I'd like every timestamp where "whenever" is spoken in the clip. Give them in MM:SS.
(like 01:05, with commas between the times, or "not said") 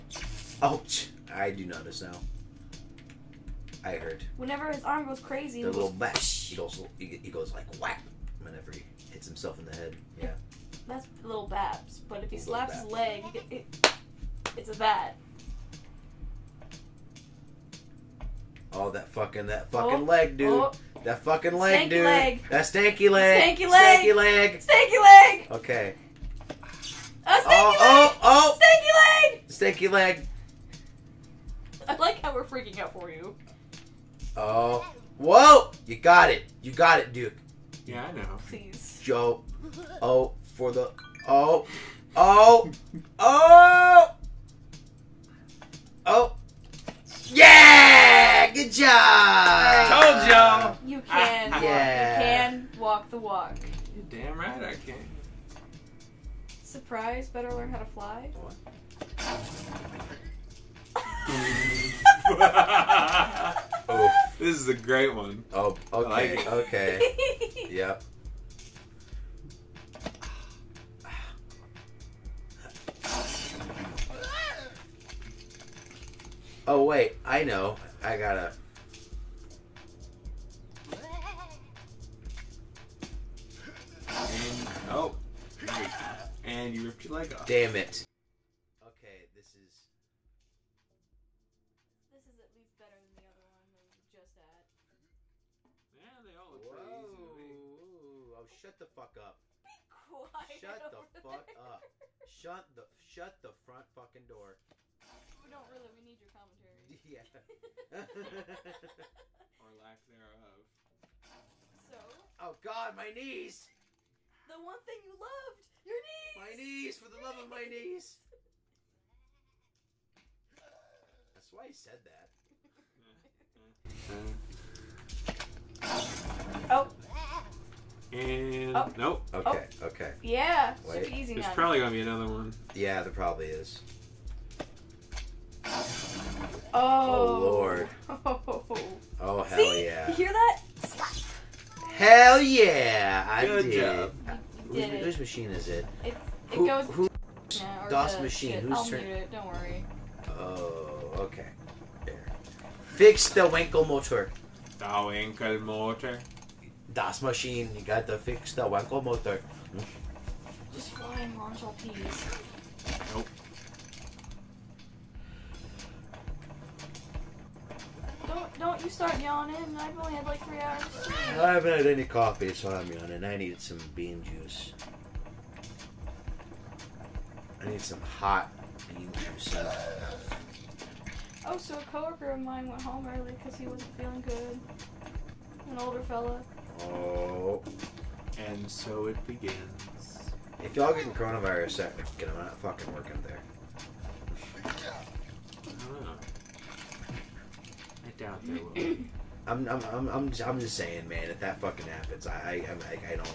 00:04, 00:08.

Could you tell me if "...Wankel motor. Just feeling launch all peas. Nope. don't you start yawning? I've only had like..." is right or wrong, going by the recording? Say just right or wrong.
wrong.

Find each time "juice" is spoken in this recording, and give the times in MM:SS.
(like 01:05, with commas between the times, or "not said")
02:54, 02:59.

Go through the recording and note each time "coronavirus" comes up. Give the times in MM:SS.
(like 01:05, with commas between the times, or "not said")
03:11.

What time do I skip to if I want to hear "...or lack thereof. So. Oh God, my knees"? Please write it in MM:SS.
01:49.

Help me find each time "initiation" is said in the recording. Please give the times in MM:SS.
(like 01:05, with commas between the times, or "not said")
not said.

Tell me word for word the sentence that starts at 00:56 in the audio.
Surprise, better learn how to fly.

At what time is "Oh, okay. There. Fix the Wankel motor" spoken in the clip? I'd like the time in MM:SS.
02:30.